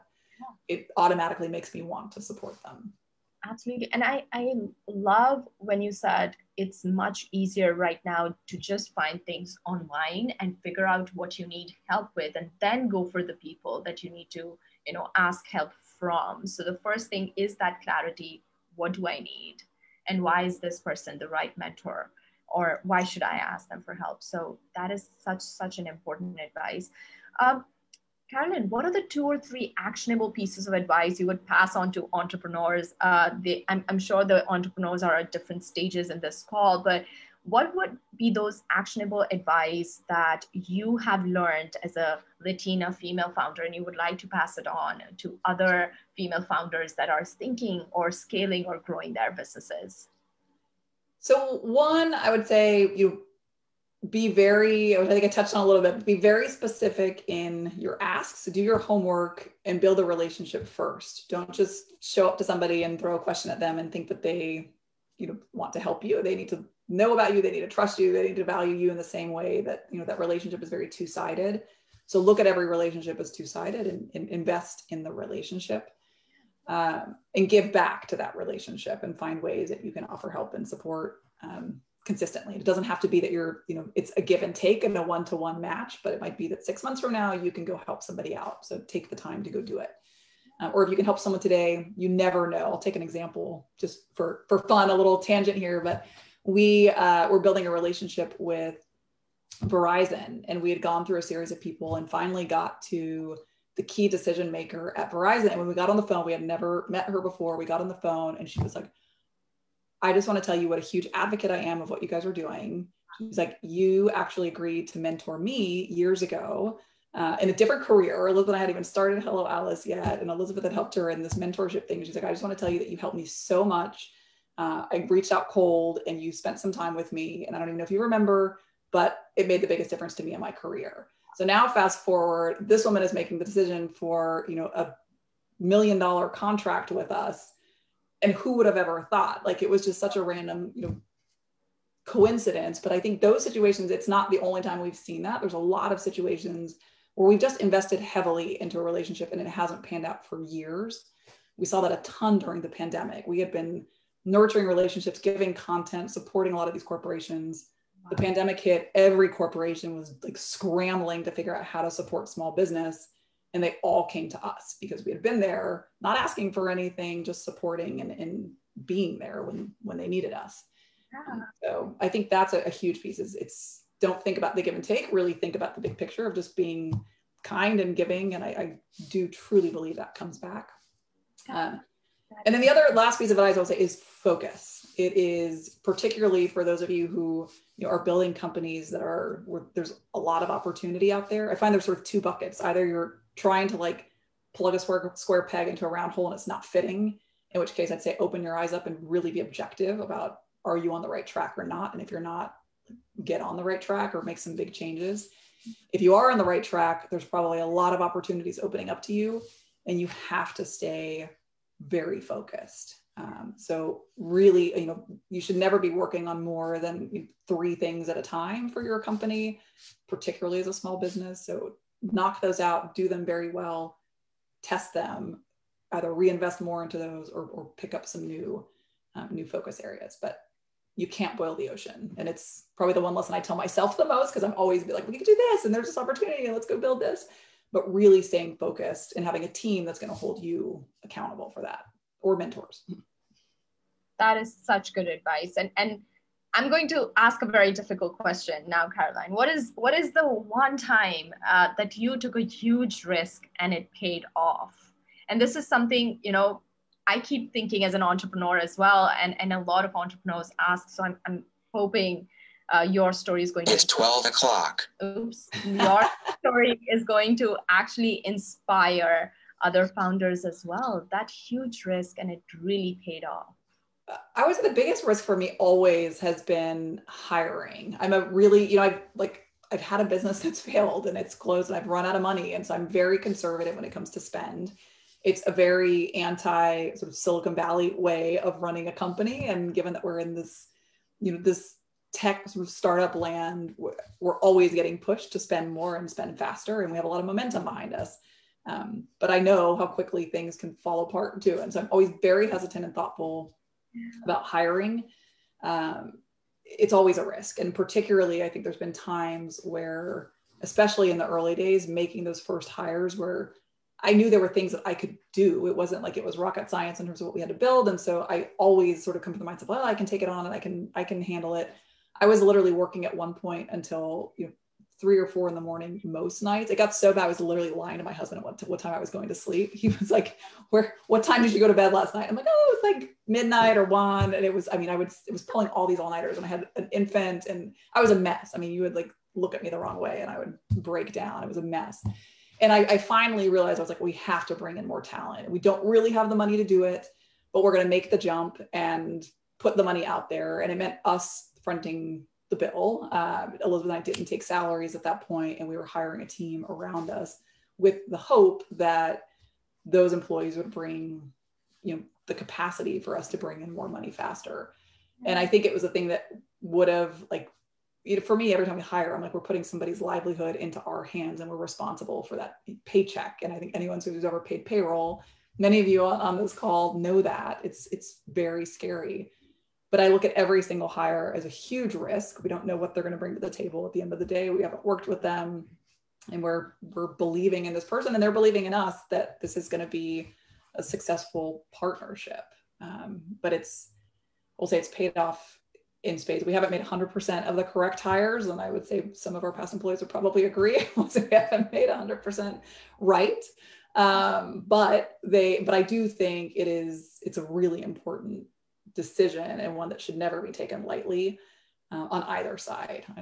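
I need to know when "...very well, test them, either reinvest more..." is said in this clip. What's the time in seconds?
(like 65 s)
223 s.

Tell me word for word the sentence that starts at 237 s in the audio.
But really staying focused and having a team that's going to hold you accountable for that or mentors.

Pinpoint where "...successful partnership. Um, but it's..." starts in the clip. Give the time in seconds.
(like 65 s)
390 s.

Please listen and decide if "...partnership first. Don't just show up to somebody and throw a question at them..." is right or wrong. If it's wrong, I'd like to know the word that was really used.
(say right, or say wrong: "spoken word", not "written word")
wrong: "relationship", not "partnership".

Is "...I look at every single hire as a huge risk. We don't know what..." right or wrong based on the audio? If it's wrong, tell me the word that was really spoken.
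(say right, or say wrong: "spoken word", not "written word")
right.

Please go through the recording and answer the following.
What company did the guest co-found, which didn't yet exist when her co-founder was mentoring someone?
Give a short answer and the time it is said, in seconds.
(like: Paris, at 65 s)
Hello Alice, at 119 s.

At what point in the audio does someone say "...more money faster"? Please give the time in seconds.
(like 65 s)
363 s.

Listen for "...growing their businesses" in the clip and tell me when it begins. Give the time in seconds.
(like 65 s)
48 s.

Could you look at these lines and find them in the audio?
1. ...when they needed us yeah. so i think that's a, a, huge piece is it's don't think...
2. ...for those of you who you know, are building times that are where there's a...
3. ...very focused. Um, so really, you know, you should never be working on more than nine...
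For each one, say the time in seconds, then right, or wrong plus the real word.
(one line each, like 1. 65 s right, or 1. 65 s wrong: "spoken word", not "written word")
1. 169 s right
2. 186 s wrong: "companies", not "times"
3. 211 s wrong: "three", not "nine".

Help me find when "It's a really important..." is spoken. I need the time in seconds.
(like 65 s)
407 s.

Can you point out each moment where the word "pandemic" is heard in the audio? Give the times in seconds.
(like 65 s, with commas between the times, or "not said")
152 s, 158 s.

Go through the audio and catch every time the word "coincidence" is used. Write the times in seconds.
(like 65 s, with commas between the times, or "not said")
142 s.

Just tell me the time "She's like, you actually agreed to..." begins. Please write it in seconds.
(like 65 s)
113 s.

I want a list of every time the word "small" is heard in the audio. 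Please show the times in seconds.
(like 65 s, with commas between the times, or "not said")
162 s, 220 s.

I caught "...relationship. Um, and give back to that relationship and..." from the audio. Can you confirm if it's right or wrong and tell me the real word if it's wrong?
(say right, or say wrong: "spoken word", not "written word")
right.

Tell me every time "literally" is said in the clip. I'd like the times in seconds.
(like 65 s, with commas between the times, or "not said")
322 s, 327 s.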